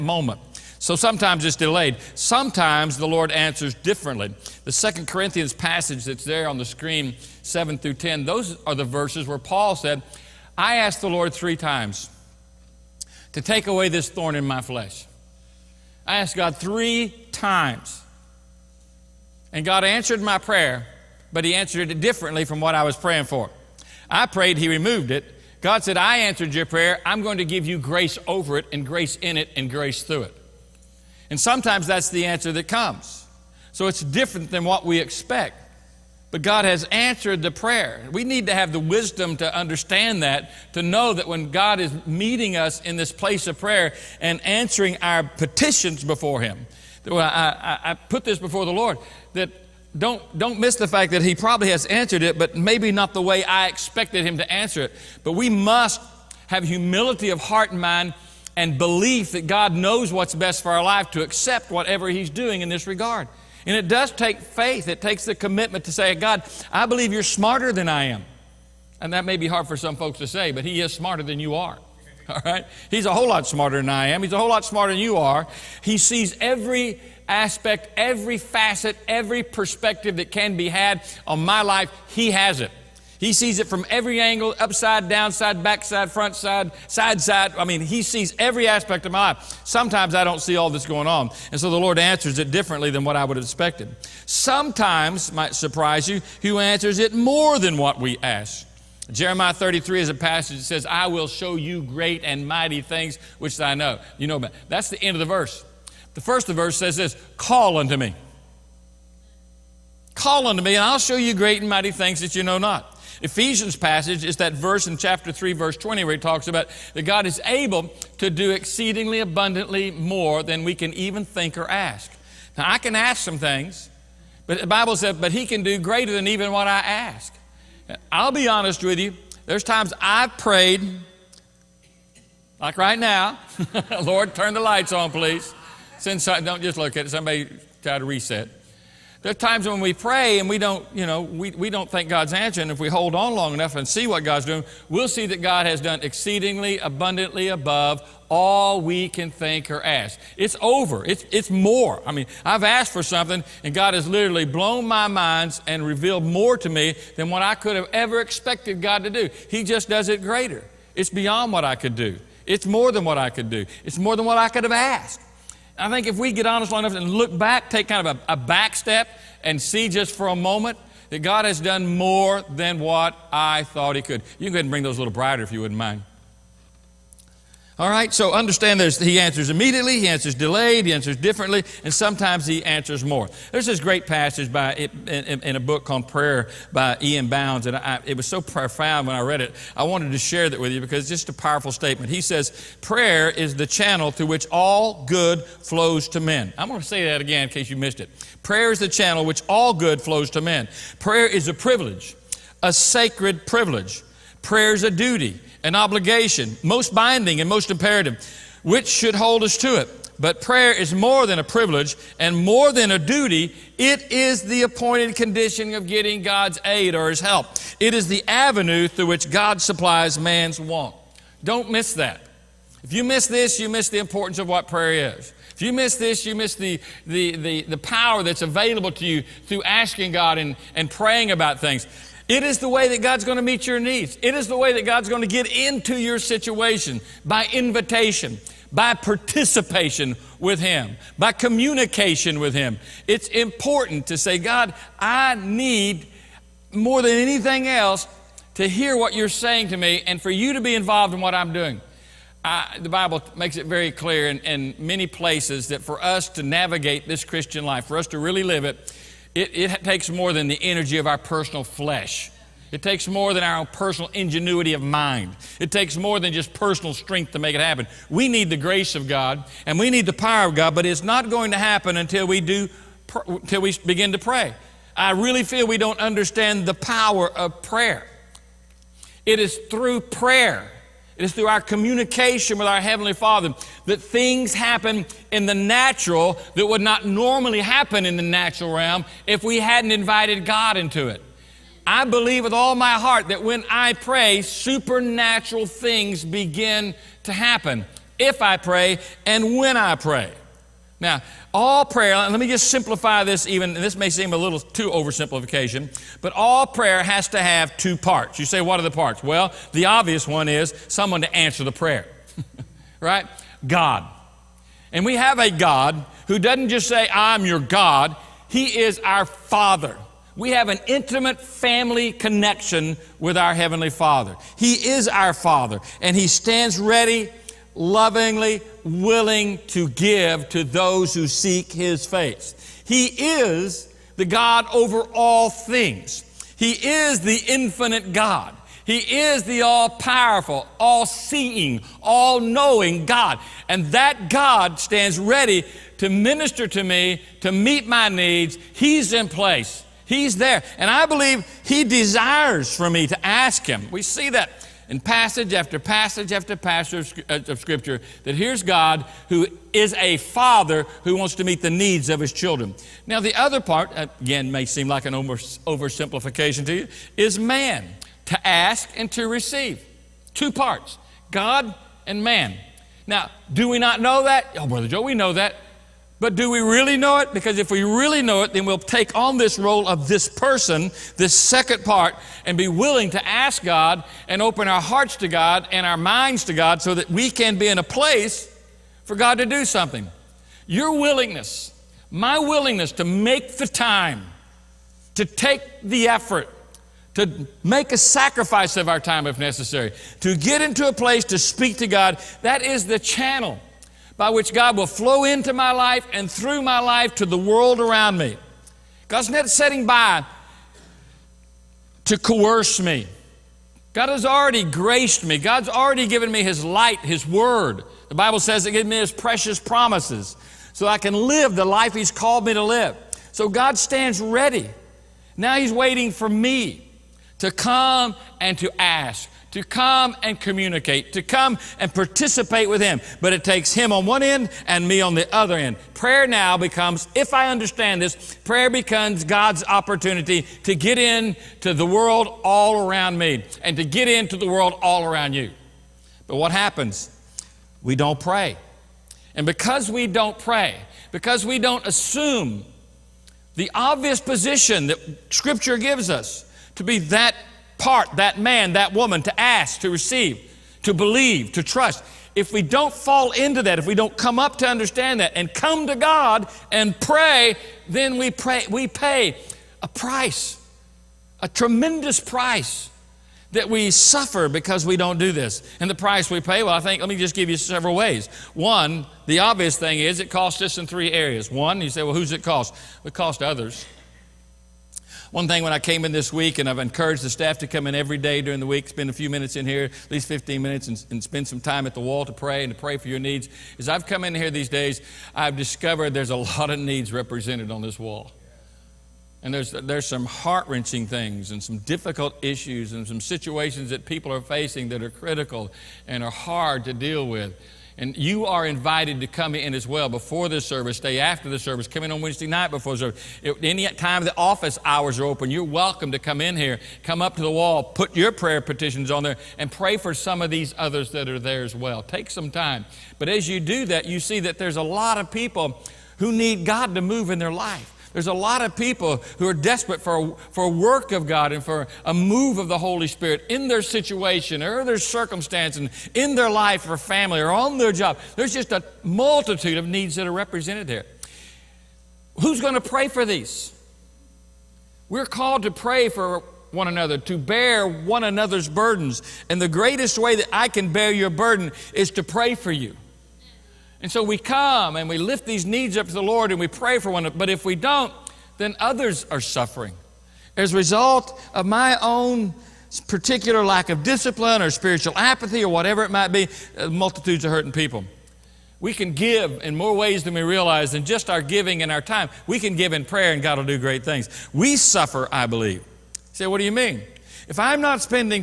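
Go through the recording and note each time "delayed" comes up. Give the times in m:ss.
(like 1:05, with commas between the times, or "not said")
0:01, 3:00.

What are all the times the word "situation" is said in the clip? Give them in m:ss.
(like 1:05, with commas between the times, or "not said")
3:56, 8:23, 8:53.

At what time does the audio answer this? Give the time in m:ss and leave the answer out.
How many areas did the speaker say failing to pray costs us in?
8:00.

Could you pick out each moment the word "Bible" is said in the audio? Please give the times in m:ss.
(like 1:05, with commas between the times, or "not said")
2:04, 4:12, 6:58.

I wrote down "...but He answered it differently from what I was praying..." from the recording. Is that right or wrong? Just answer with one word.
right.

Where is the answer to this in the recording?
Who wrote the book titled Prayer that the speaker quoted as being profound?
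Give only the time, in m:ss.
3:07.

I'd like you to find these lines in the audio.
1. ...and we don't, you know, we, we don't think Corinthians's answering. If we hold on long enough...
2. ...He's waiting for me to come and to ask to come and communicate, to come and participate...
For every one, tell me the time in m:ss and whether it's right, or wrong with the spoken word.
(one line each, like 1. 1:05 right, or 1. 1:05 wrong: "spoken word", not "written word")
1. 2:20 wrong: "God", not "Corinthians"
2. 7:05 right.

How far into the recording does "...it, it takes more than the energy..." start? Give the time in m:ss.
4:19.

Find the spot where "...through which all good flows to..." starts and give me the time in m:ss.
3:14.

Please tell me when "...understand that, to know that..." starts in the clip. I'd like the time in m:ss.
0:39.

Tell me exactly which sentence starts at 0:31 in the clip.
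And sometimes that's the answer that comes.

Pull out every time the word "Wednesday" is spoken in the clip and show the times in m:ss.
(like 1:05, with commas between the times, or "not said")
8:32.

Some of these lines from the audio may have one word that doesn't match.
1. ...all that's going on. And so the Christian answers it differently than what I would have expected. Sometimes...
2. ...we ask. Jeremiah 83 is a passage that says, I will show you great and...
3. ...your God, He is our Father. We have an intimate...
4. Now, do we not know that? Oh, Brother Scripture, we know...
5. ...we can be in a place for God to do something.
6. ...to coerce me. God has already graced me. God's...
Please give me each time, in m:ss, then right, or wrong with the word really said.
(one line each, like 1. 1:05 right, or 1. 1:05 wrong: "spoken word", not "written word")
1. 1:30 wrong: "Lord", not "Christian"
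2. 1:37 wrong: "33", not "83"
3. 5:17 right
4. 6:13 wrong: "Joe", not "Scripture"
5. 6:27 right
6. 6:52 right.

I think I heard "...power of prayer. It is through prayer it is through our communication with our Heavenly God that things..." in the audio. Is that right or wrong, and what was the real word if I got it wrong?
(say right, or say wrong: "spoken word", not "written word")
wrong: "Father", not "God".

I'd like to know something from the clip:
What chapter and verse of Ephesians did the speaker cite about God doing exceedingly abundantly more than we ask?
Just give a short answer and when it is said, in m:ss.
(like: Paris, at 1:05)
Chapter 3, verse 20, at 1:54.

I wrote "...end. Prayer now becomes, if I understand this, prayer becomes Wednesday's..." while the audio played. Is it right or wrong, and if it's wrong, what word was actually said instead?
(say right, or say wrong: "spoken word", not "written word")
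wrong: "God", not "Wednesday".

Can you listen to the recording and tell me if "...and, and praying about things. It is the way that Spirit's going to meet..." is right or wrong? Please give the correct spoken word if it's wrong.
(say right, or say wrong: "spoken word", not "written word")
wrong: "God", not "Spirit".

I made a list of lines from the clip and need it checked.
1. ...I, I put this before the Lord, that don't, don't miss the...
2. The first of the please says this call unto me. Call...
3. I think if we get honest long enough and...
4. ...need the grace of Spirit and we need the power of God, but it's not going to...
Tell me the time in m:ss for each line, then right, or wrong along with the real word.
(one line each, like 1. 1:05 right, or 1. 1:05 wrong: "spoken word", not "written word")
1. 0:47 right
2. 1:46 wrong: "verse", not "please"
3. 2:45 right
4. 4:28 wrong: "God", not "Spirit".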